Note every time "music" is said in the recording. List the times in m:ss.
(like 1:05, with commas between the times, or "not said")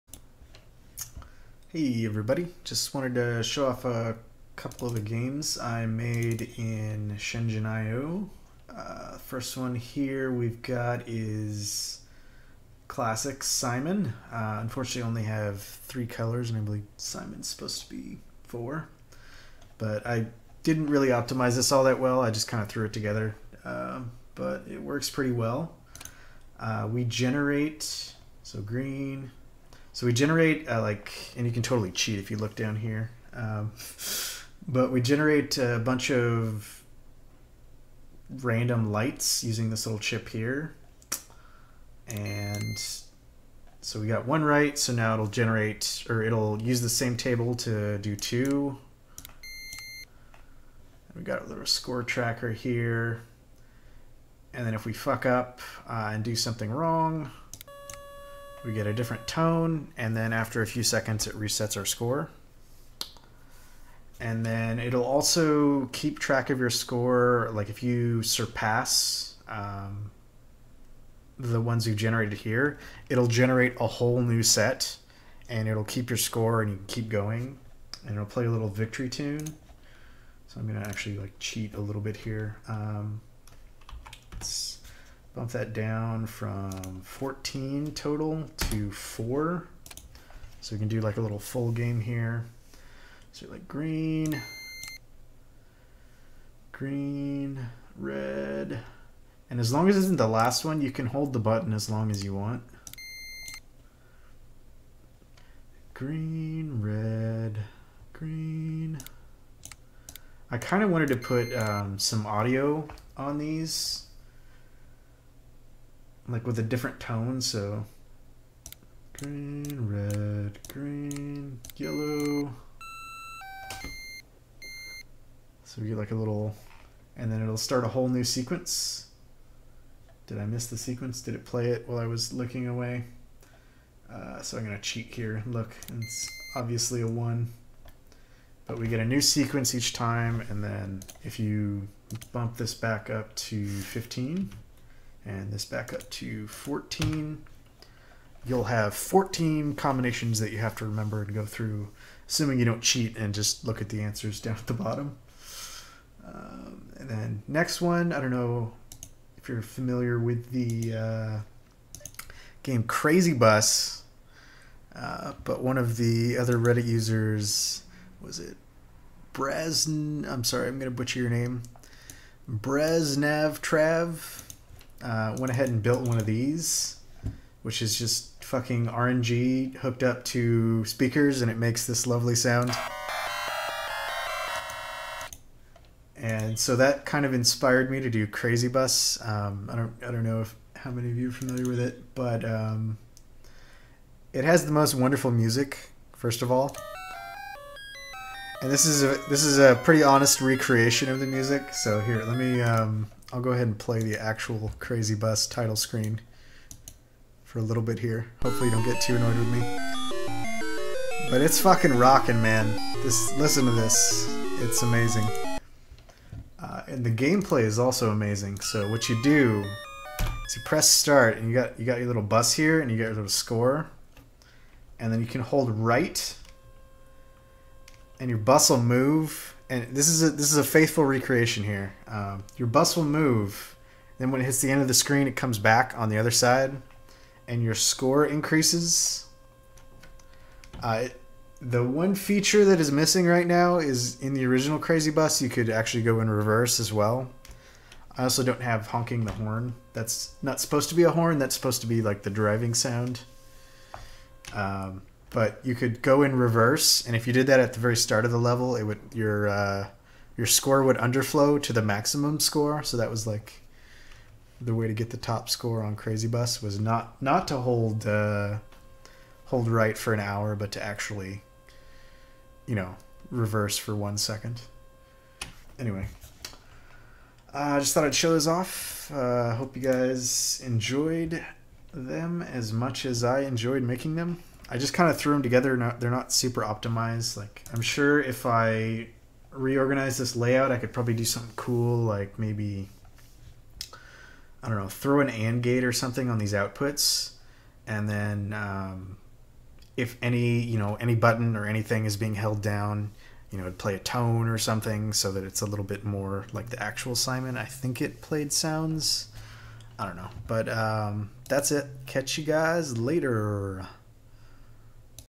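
3:15, 3:21.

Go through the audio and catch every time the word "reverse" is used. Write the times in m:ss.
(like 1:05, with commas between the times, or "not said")
4:06, 4:16, 4:33.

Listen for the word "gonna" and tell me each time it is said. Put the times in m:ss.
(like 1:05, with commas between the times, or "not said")
1:20, 2:14.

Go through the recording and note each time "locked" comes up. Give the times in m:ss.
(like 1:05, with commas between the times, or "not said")
not said.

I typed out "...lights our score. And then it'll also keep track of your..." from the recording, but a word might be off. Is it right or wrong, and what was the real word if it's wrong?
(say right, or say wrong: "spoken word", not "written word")
wrong: "resets", not "lights".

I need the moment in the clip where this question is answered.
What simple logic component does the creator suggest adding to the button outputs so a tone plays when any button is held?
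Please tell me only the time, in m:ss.
4:55.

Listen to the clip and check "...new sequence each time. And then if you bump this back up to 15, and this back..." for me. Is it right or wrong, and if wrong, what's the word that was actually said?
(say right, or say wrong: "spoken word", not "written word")
right.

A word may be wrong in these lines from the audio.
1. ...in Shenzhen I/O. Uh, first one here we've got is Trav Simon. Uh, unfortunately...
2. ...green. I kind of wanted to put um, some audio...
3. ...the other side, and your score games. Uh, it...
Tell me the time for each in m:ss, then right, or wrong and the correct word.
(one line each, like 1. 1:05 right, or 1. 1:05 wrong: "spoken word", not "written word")
1. 0:06 wrong: "Classic", not "Trav"
2. 1:48 right
3. 3:56 wrong: "increases", not "games".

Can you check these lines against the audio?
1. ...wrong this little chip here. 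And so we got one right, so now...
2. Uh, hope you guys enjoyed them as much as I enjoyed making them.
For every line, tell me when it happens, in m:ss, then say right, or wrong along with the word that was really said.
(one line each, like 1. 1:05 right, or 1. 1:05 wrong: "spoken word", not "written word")
1. 0:39 wrong: "using", not "wrong"
2. 4:39 right.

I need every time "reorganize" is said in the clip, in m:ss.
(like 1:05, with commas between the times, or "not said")
4:49.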